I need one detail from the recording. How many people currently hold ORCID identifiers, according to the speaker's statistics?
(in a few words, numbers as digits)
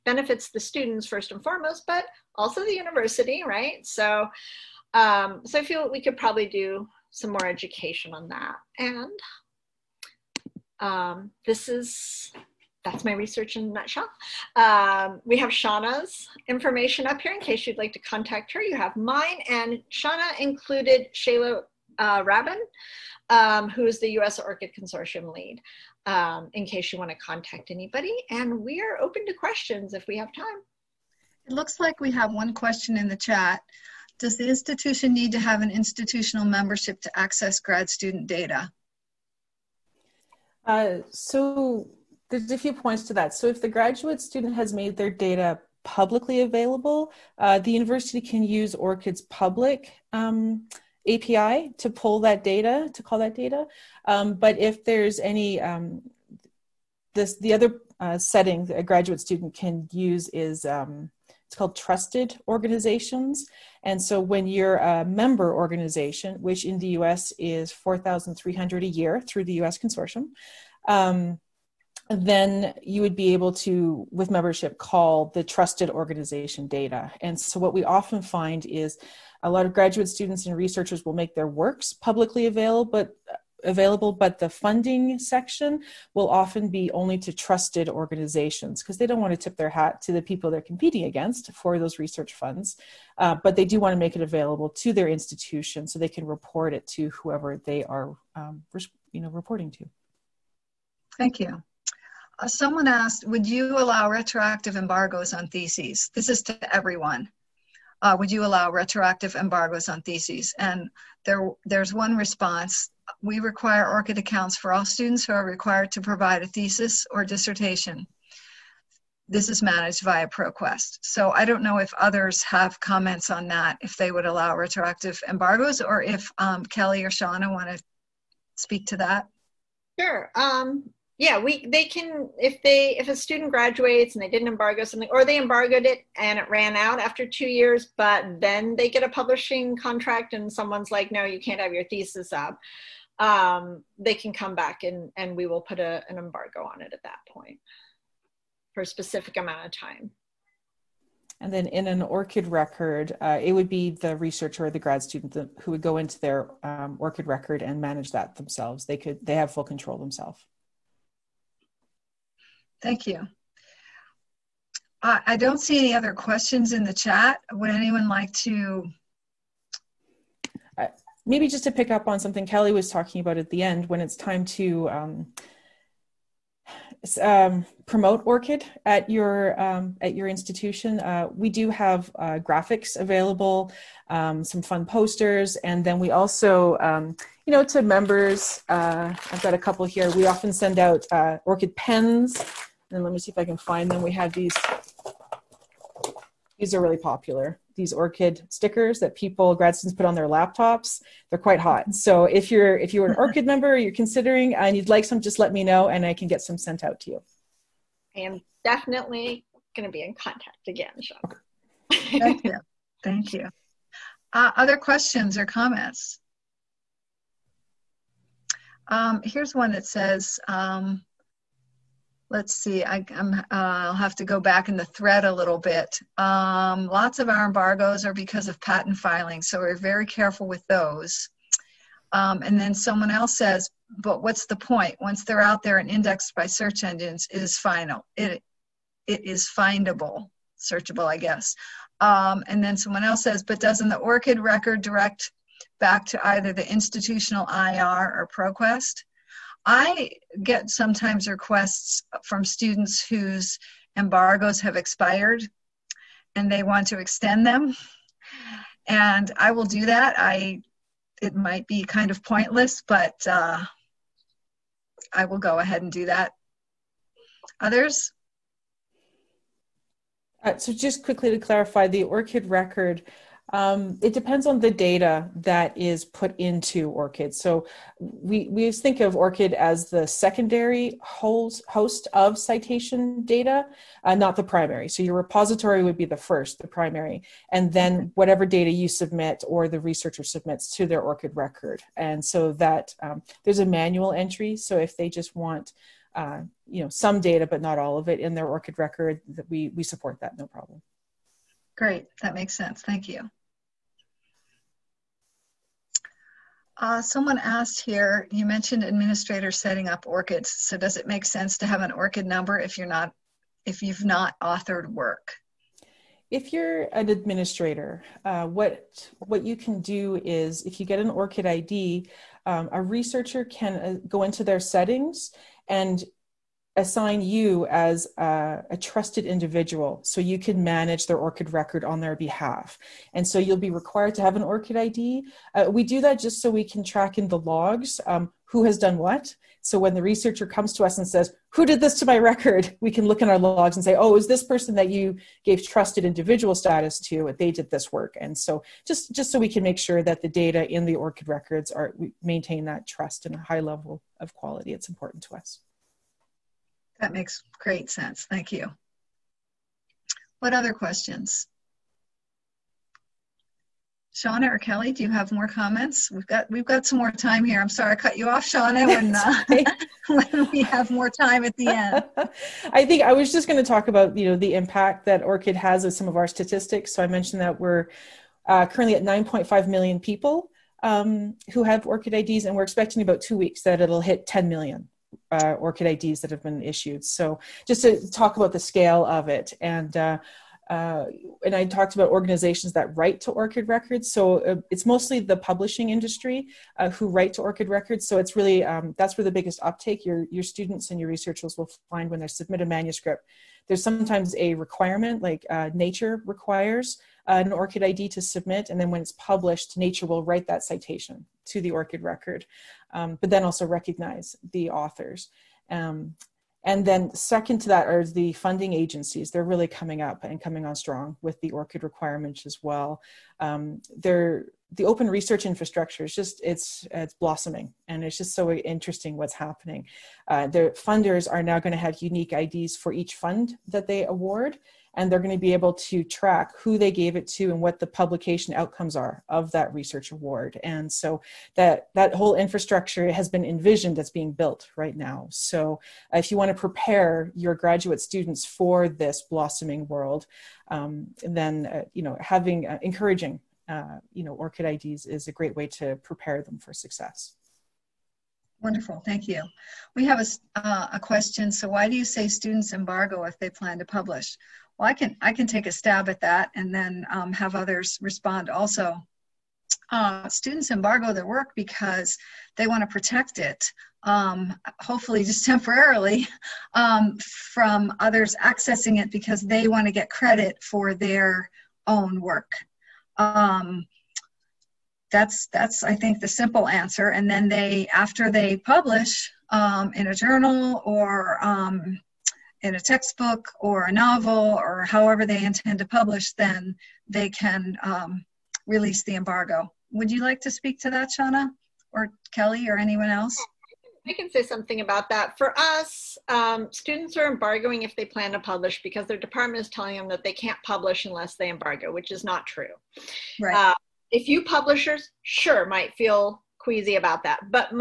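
9.5 million.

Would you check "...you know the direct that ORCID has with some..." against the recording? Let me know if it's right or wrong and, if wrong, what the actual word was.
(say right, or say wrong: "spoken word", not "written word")
wrong: "impact", not "direct".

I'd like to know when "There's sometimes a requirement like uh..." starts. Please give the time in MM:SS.
06:43.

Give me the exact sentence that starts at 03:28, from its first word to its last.
I am definitely going to be in contact again, Sean.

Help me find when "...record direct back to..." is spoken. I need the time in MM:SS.
04:04.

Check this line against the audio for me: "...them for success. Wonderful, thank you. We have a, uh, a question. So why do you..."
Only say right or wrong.
right.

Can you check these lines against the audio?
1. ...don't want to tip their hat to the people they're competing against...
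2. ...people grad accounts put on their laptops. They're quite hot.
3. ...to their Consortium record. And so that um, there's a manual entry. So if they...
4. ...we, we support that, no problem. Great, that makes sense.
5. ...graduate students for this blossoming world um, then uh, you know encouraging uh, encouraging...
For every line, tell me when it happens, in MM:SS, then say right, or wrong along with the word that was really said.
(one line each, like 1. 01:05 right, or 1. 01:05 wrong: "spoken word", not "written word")
1. 01:29 right
2. 03:19 wrong: "students", not "accounts"
3. 04:50 wrong: "ORCID", not "Consortium"
4. 04:59 right
5. 07:27 wrong: "having", not "encouraging".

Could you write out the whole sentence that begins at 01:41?
Thank you someone asked, would you allow retroactive embargoes on theses?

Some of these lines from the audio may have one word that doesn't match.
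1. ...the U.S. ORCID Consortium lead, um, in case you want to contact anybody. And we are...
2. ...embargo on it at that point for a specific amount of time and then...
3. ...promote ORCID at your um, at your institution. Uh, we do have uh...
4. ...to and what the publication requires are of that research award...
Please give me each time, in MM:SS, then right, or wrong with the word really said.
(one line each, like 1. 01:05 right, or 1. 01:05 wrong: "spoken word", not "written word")
1. 00:23 right
2. 02:26 right
3. 02:57 right
4. 07:17 wrong: "outcomes", not "requires".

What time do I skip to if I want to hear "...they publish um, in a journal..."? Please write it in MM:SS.
08:08.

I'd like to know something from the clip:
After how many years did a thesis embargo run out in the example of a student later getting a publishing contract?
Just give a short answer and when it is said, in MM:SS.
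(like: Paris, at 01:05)
2, at 02:17.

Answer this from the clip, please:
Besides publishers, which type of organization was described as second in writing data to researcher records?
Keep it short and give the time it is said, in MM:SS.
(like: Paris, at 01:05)
funding agencies, at 06:58.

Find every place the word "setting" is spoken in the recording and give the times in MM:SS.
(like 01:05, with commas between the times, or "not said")
00:58, 05:09, 05:24.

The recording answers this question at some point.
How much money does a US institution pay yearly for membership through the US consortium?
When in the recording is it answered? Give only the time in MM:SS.
01:07.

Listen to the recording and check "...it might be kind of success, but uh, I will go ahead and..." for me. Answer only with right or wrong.
wrong.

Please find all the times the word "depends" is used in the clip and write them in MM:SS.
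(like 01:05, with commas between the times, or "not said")
04:34.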